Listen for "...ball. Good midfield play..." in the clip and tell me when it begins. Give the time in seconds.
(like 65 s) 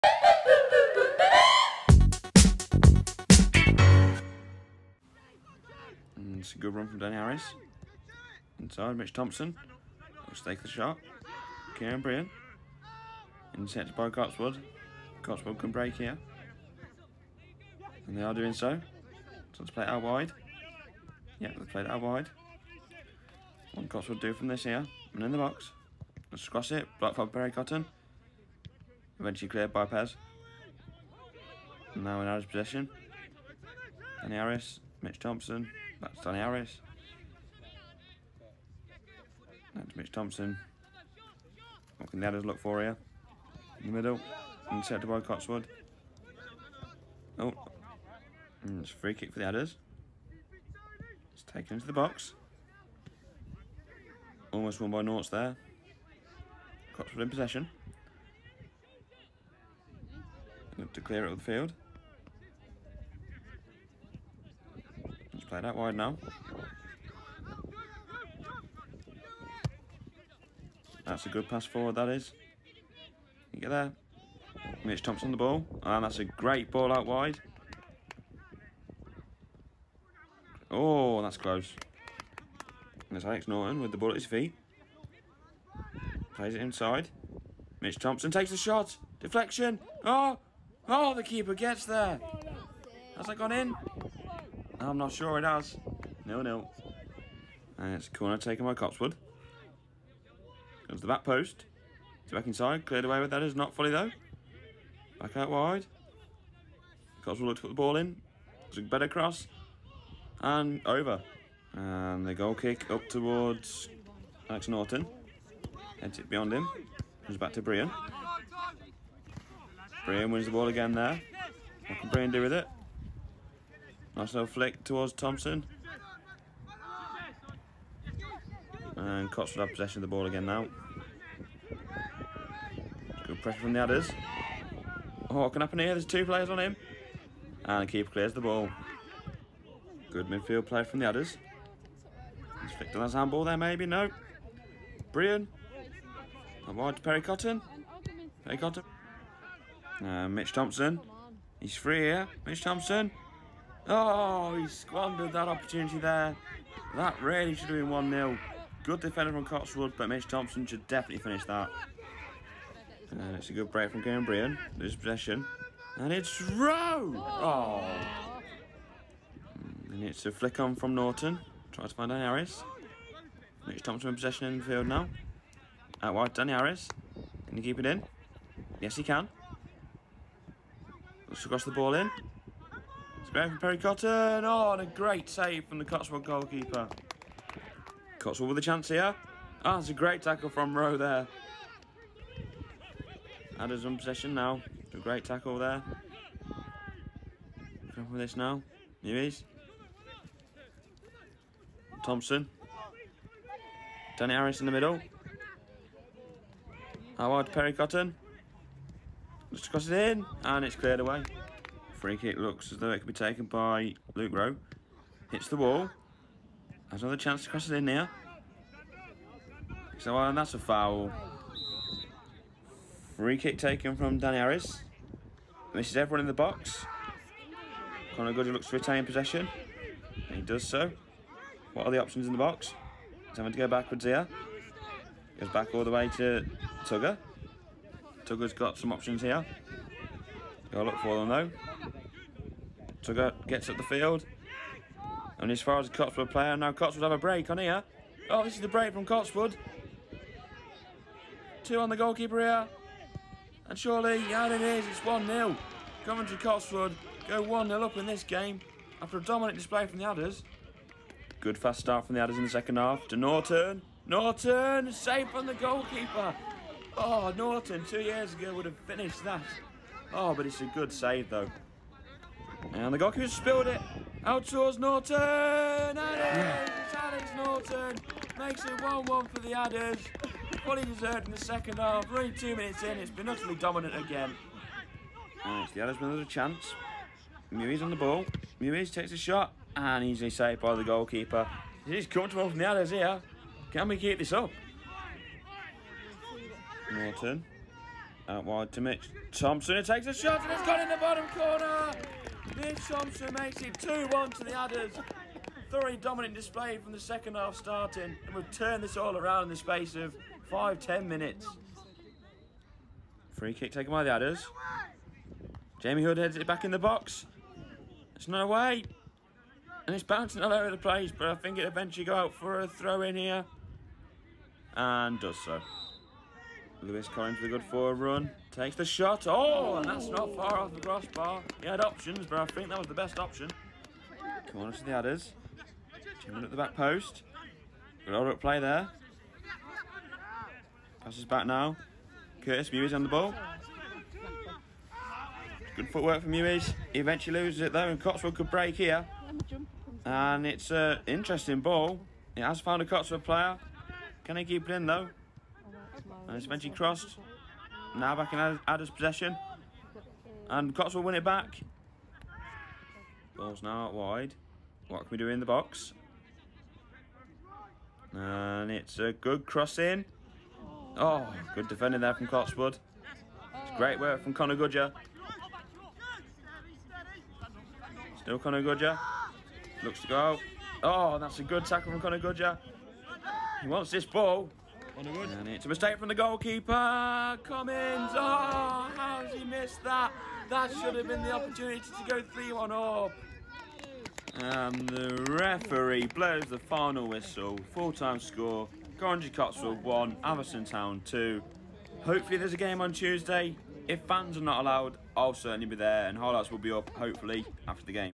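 138 s.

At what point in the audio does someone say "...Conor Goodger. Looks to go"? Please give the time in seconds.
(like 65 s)
378 s.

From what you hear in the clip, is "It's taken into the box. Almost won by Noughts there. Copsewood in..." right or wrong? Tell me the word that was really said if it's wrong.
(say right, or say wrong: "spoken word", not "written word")
right.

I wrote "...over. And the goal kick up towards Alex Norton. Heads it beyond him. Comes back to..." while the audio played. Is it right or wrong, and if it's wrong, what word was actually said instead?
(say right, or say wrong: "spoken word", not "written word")
right.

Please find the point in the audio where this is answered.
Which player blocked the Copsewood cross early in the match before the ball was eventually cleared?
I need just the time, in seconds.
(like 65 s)
27 s.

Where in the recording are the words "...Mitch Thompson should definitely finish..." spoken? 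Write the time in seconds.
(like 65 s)
160 s.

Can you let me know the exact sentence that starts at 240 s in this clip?
Gotta look for them though to go, gets up the field.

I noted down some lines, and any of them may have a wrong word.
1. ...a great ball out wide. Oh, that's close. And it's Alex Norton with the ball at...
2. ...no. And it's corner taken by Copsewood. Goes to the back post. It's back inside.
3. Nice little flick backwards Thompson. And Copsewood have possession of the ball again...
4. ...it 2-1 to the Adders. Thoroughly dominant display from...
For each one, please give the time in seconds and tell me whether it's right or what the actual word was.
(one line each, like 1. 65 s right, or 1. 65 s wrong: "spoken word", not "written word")
1. 76 s right
2. 96 s right
3. 124 s wrong: "towards", not "backwards"
4. 303 s right.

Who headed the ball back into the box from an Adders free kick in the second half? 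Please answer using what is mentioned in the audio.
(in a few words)
Jamie Hood.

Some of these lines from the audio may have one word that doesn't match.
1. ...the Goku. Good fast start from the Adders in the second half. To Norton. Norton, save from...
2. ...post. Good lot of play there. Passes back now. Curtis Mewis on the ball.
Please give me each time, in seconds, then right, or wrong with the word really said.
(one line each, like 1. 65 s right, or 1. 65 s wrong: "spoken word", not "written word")
1. 259 s wrong: "Adders", not "Goku"
2. 336 s right.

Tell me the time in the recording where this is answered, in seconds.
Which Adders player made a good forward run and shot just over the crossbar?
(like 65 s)
326 s.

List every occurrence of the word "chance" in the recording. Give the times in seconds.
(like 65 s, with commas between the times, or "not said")
188 s, 217 s, 286 s.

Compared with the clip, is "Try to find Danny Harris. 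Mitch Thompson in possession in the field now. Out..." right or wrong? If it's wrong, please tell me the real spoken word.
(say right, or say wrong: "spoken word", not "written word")
right.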